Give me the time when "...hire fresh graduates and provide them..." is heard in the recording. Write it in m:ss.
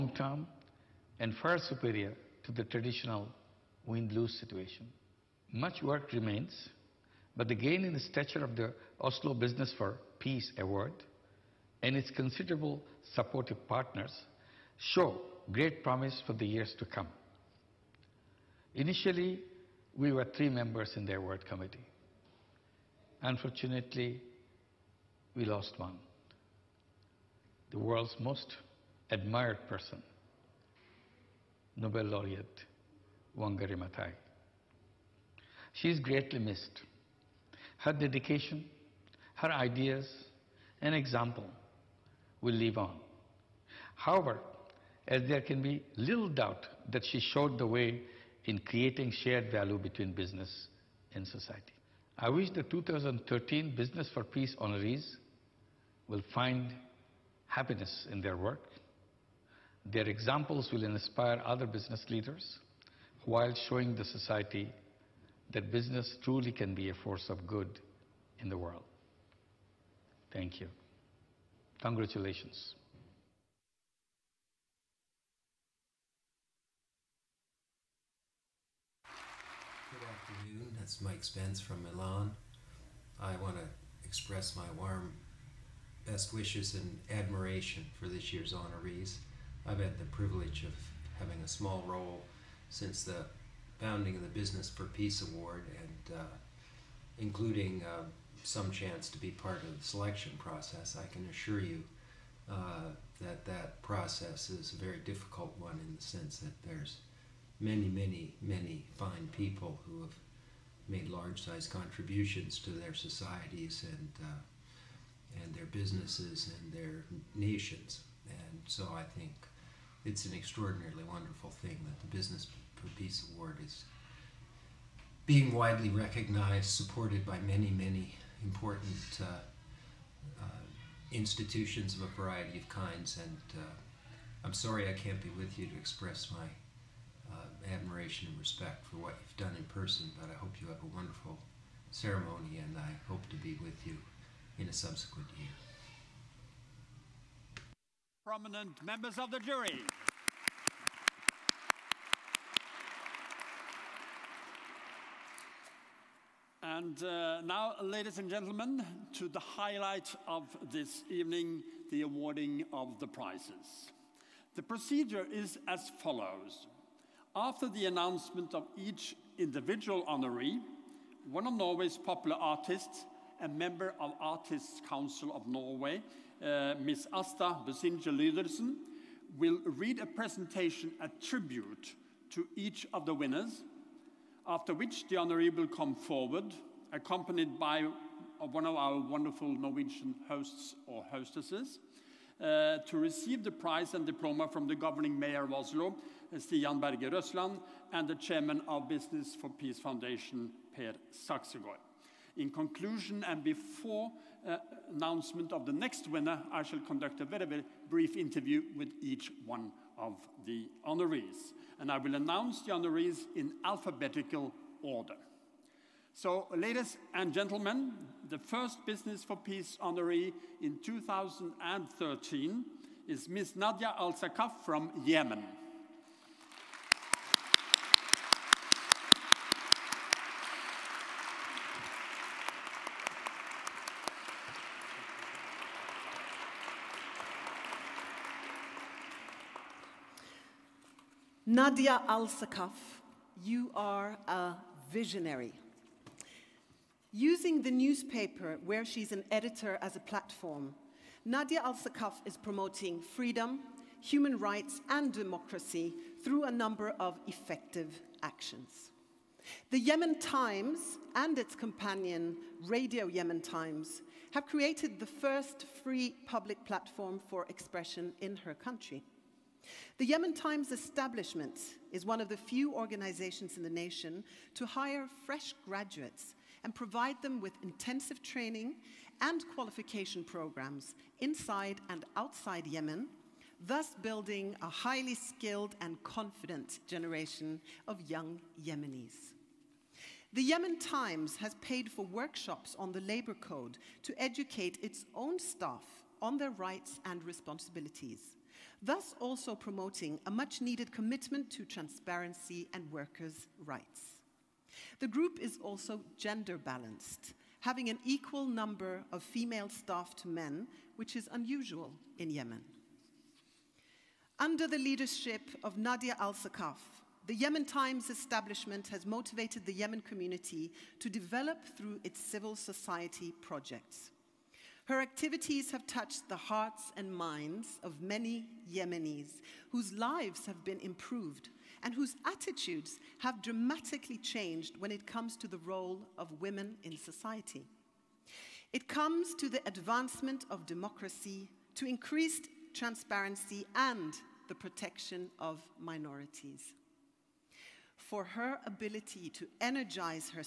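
4:34.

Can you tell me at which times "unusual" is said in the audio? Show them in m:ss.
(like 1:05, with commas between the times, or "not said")
5:11.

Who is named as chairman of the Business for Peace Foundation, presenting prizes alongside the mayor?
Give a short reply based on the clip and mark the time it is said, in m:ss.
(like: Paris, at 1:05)
Per Saxegaard, at 3:20.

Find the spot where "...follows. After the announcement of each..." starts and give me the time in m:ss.
2:46.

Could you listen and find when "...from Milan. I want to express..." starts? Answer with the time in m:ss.
1:21.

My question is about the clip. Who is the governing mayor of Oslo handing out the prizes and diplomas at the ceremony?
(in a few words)
Stian Berger Røsland.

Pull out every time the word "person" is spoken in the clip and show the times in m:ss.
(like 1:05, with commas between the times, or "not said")
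0:29, 2:19.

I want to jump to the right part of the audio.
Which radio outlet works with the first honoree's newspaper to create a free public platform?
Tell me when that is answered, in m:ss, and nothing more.
4:22.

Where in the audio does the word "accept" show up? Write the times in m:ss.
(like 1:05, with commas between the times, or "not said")
not said.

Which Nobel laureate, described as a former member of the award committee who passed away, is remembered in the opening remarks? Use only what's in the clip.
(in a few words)
Wangari Maathai.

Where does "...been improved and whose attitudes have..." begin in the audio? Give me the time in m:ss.
5:30.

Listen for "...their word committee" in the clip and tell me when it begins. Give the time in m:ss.
0:21.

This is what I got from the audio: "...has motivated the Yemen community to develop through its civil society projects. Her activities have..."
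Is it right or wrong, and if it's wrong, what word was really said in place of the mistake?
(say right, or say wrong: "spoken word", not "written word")
right.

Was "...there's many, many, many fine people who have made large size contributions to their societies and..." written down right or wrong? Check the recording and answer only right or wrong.
right.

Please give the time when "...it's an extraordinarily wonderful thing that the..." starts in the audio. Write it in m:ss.
2:00.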